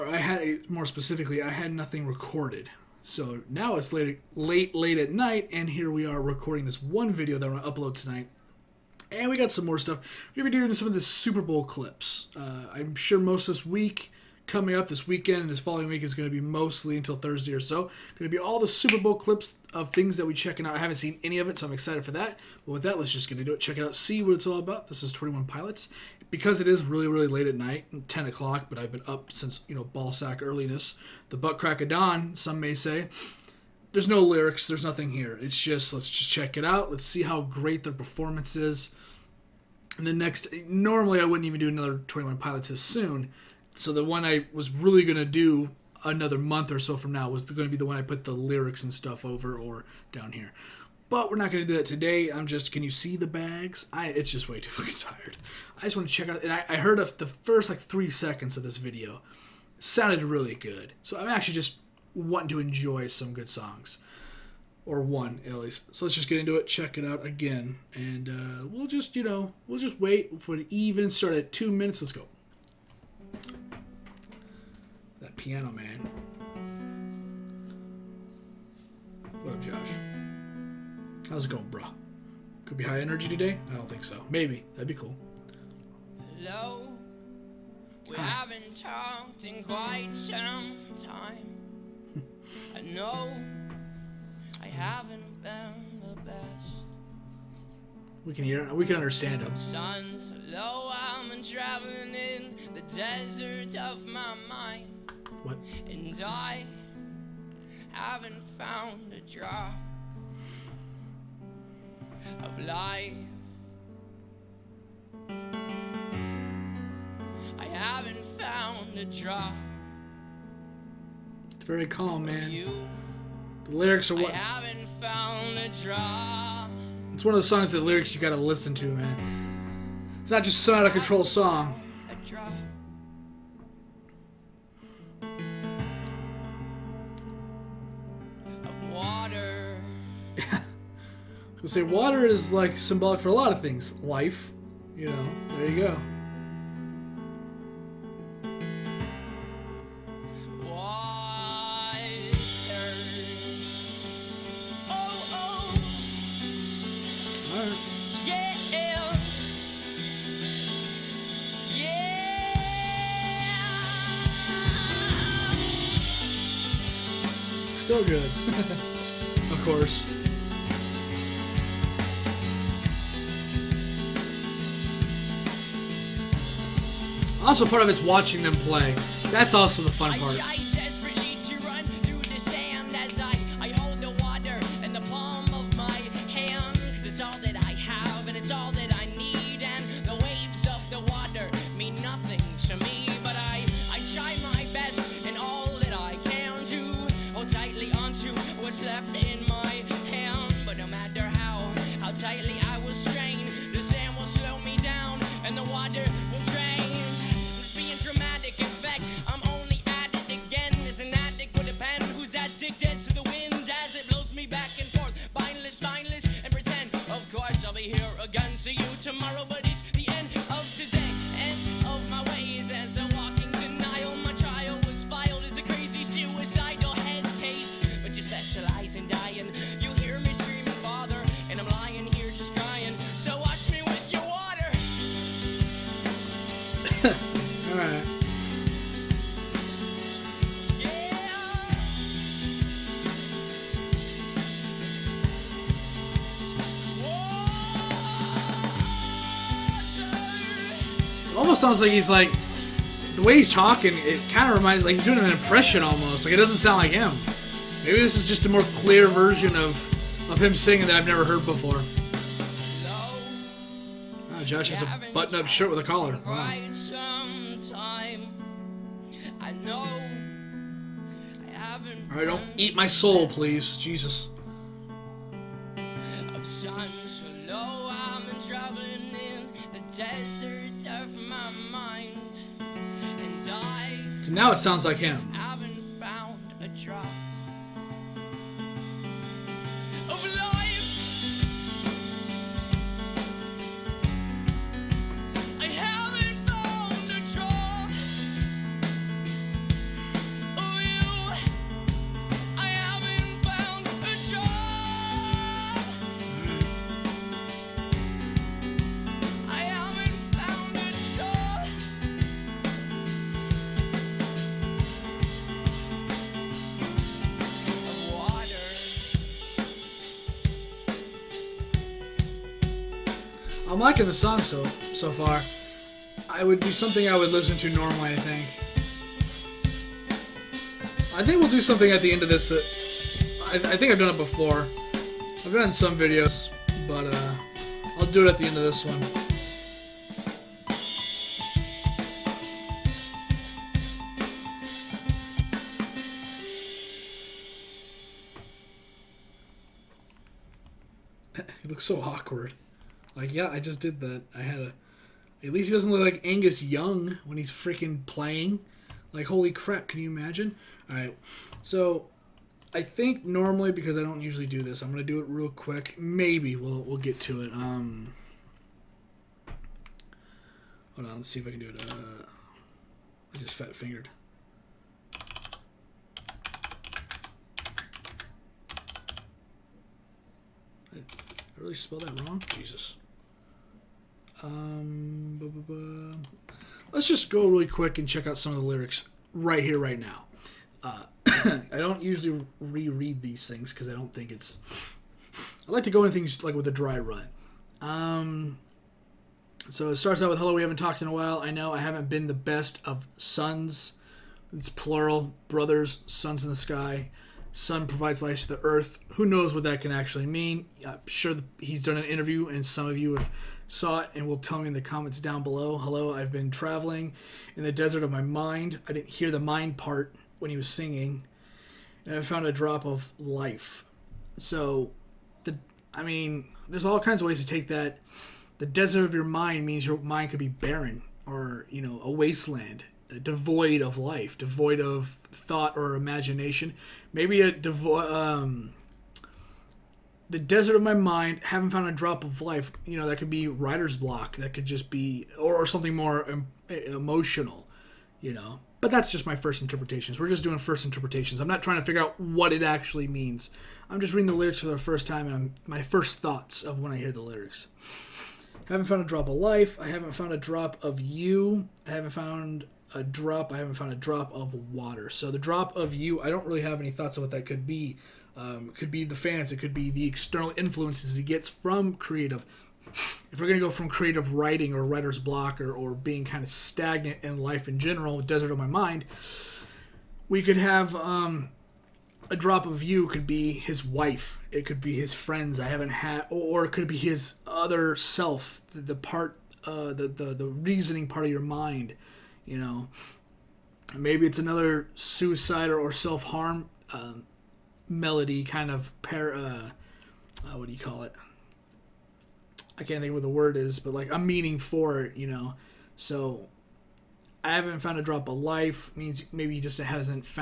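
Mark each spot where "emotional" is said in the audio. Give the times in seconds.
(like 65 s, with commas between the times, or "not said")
446 s.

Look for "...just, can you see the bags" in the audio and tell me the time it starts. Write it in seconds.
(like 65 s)
52 s.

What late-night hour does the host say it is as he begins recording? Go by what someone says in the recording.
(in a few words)
10 o'clock.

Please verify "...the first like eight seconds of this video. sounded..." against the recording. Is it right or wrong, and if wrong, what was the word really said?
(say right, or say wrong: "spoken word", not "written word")
wrong: "three", not "eight".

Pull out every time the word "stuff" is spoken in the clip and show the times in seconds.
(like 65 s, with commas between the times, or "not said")
9 s, 48 s.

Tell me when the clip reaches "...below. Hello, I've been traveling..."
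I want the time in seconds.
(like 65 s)
415 s.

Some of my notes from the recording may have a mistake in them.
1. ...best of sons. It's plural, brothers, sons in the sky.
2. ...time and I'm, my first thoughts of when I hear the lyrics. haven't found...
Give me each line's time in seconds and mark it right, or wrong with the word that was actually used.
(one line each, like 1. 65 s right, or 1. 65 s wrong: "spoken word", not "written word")
1. 402 s right
2. 455 s right.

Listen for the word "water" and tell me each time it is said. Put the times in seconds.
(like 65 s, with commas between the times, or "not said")
141 s, 464 s.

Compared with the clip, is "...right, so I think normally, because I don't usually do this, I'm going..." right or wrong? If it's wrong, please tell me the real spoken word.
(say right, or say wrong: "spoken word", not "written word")
right.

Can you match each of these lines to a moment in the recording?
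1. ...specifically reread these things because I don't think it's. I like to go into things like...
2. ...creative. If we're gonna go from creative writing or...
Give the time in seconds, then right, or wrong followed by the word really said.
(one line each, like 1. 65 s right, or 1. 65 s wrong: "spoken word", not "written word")
1. 392 s wrong: "usually", not "specifically"
2. 471 s right.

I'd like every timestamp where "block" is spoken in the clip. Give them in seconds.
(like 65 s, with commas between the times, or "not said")
443 s, 475 s.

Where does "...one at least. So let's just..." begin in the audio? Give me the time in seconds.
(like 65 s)
65 s.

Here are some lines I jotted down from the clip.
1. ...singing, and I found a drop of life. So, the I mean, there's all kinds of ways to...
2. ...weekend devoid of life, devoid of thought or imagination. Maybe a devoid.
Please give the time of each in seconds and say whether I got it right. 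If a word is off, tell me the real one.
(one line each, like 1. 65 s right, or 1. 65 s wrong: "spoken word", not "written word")
1. 420 s right
2. 432 s wrong: "wasteland", not "weekend".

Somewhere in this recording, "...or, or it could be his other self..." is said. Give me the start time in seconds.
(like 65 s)
486 s.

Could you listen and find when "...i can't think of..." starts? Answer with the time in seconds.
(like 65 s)
502 s.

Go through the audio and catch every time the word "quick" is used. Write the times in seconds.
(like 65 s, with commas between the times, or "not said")
365 s, 387 s.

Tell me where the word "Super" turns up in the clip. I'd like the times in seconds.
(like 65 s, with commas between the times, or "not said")
10 s, 18 s.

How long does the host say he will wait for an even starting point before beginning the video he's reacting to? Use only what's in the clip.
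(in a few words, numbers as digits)
two minutes.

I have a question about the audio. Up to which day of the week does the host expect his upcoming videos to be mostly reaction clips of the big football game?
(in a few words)
Thursday.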